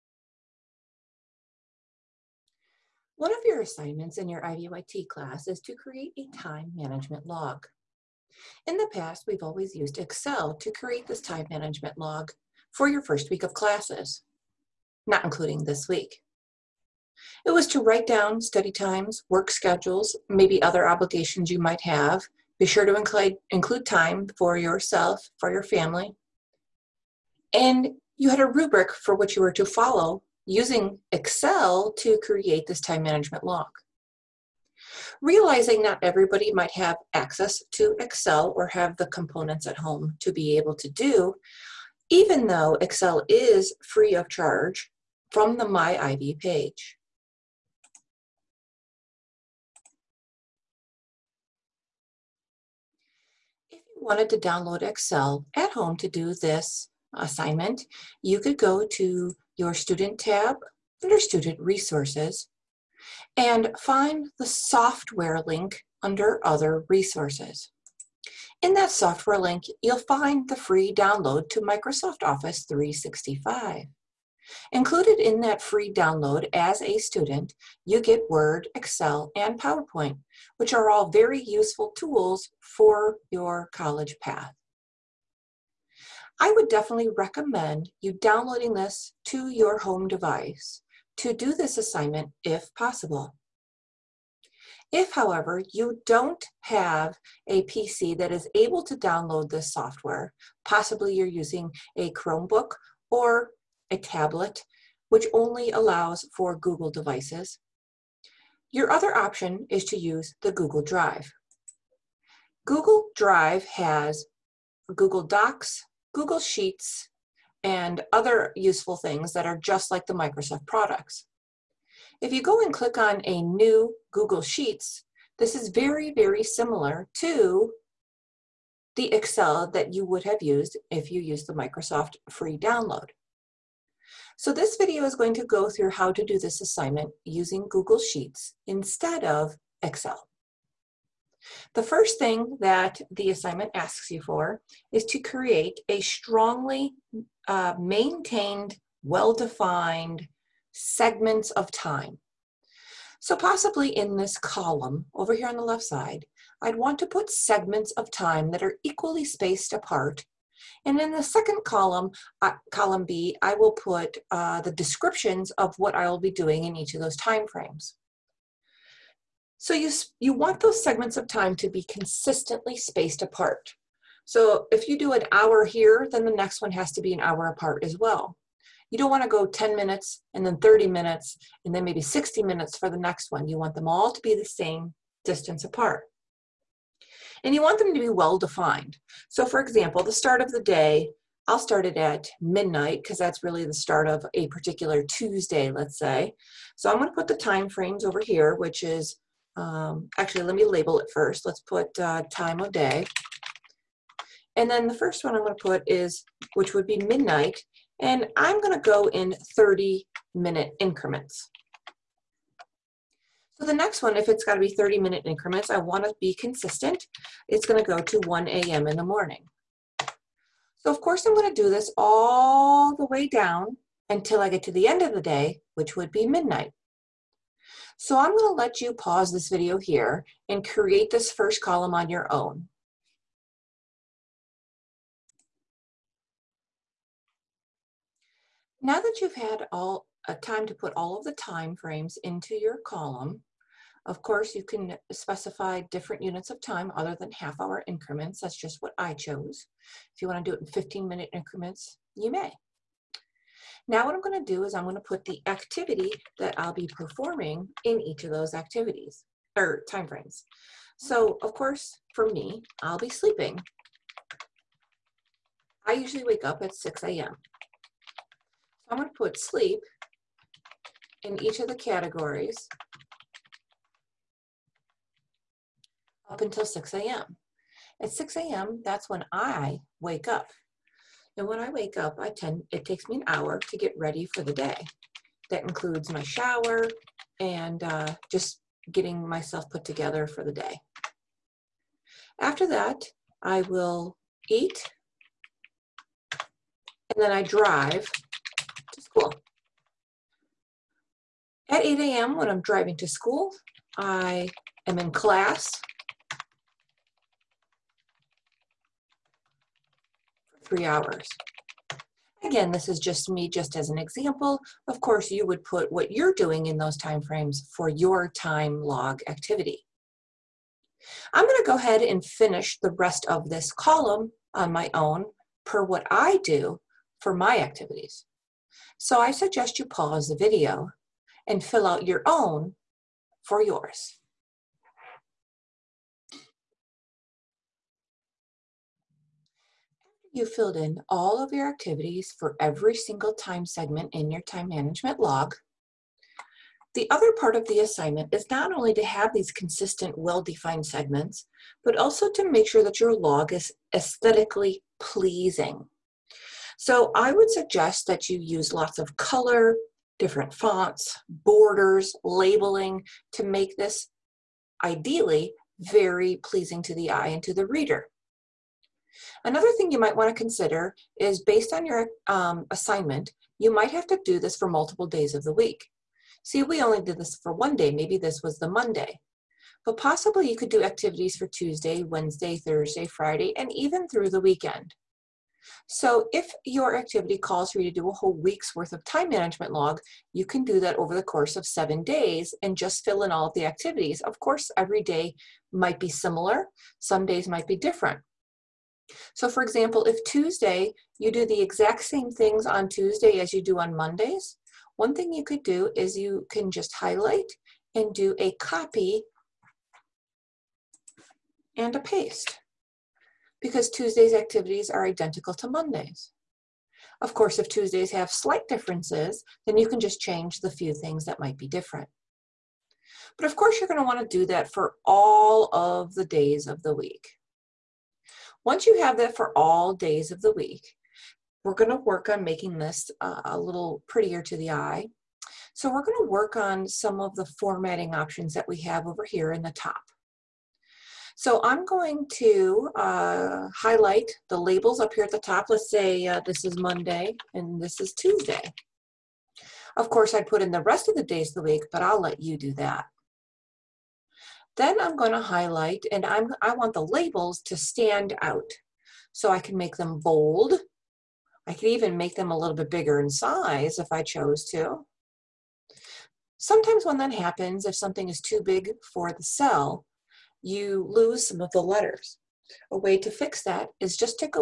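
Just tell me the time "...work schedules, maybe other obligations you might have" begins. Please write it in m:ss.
0:19.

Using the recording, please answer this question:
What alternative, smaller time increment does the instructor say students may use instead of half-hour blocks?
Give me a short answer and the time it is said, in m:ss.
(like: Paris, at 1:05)
15 minutes, at 4:10.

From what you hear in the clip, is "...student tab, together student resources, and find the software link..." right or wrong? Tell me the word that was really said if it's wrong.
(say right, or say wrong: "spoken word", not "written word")
wrong: "under", not "together".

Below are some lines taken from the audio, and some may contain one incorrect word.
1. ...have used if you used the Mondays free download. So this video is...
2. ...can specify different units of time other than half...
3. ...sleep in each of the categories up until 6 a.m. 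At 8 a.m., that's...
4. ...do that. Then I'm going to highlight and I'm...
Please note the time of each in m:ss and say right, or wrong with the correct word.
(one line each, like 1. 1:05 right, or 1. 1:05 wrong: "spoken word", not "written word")
1. 2:10 wrong: "Microsoft", not "Mondays"
2. 4:04 right
3. 4:29 wrong: "6", not "8"
4. 7:32 right.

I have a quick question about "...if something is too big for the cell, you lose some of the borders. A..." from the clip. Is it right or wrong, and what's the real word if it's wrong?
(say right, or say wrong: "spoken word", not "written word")
wrong: "letters", not "borders".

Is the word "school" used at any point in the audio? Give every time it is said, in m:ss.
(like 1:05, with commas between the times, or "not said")
4:59, 5:03.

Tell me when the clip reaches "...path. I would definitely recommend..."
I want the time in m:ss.
1:24.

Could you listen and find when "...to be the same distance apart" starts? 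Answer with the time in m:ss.
3:04.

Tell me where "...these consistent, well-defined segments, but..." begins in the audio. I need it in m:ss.
5:49.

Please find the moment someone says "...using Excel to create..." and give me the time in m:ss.
0:30.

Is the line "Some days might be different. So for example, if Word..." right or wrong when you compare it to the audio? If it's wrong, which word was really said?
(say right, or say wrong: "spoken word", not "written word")
wrong: "Tuesday", not "Word".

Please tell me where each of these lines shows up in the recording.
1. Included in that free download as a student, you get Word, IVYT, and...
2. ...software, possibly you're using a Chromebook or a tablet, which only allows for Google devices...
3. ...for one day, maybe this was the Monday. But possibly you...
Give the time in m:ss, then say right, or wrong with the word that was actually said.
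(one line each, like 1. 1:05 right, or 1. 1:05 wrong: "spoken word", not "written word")
1. 1:14 wrong: "Excel", not "IVYT"
2. 1:39 right
3. 6:17 right.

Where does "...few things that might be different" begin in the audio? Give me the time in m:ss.
7:00.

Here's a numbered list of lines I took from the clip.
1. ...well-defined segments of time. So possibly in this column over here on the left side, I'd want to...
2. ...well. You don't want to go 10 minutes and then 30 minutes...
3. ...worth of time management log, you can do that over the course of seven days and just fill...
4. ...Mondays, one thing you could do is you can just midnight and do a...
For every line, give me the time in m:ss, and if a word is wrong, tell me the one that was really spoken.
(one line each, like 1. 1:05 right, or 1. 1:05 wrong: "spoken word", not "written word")
1. 2:29 right
2. 2:57 right
3. 6:28 right
4. 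6:43 wrong: "highlight", not "midnight".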